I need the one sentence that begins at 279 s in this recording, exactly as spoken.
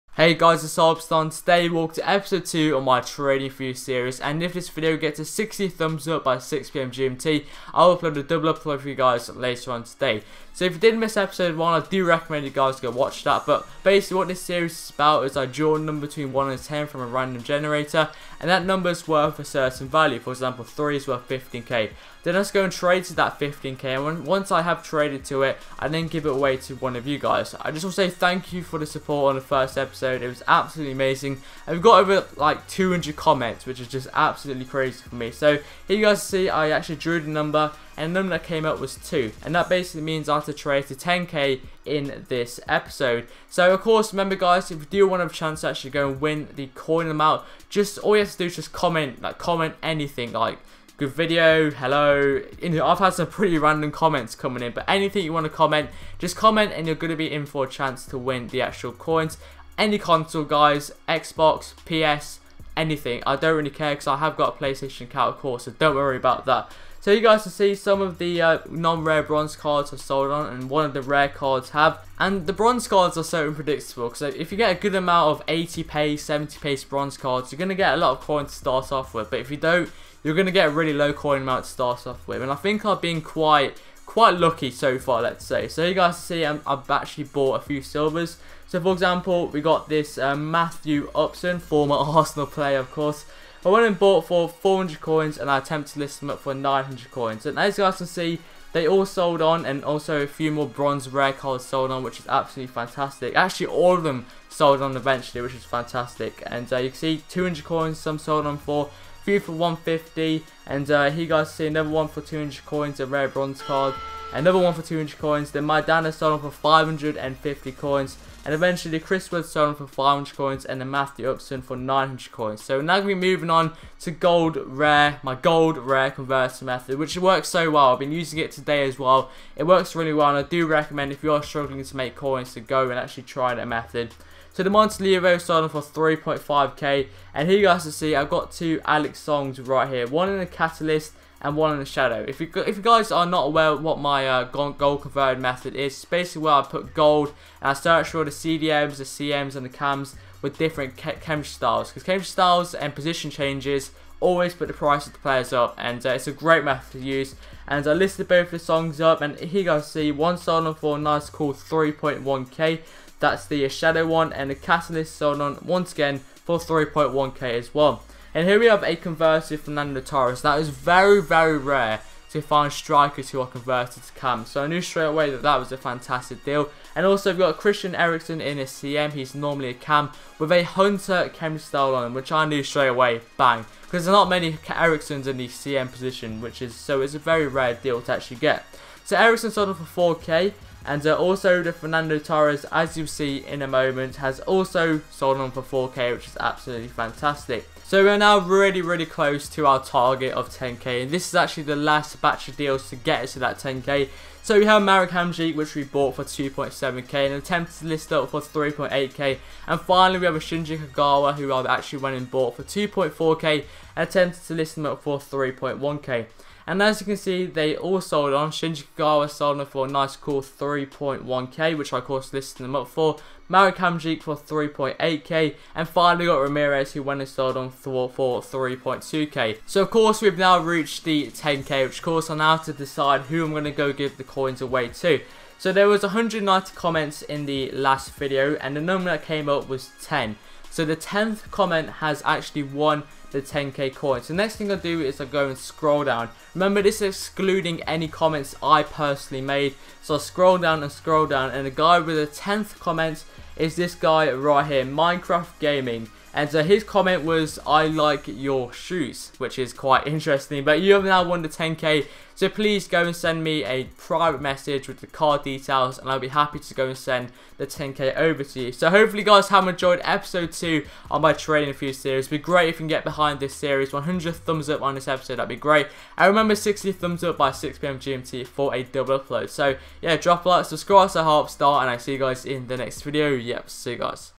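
So yeah, drop a like, subscribe, so help start, and I see you guys in the next video.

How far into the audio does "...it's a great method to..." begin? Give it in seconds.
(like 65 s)
156 s.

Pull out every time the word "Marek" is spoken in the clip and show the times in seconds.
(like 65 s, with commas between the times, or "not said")
204 s, 223 s.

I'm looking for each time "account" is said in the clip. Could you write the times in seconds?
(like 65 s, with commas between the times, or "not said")
65 s.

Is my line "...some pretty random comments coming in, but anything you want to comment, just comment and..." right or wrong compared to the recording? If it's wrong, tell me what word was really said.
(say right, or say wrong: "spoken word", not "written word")
right.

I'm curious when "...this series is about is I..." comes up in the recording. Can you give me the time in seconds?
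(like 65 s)
14 s.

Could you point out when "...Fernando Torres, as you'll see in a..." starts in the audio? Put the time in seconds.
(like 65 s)
191 s.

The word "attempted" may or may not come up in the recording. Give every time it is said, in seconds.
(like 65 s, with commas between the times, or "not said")
95 s, 207 s, 214 s.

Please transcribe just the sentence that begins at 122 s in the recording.
So now we're moving on to gold rare, my gold rare conversion method, which works so well.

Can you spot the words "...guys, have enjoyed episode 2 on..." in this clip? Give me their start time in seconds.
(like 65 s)
269 s.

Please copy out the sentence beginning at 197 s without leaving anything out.
So we're now really, really close to our target of 10k.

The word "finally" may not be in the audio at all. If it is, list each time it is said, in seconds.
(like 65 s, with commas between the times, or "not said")
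209 s, 225 s.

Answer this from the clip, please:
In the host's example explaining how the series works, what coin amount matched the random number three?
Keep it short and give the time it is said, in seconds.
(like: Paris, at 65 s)
15k, at 20 s.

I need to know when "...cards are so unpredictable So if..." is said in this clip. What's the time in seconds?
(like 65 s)
72 s.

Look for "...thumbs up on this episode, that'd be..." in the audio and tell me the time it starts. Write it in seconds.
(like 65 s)
274 s.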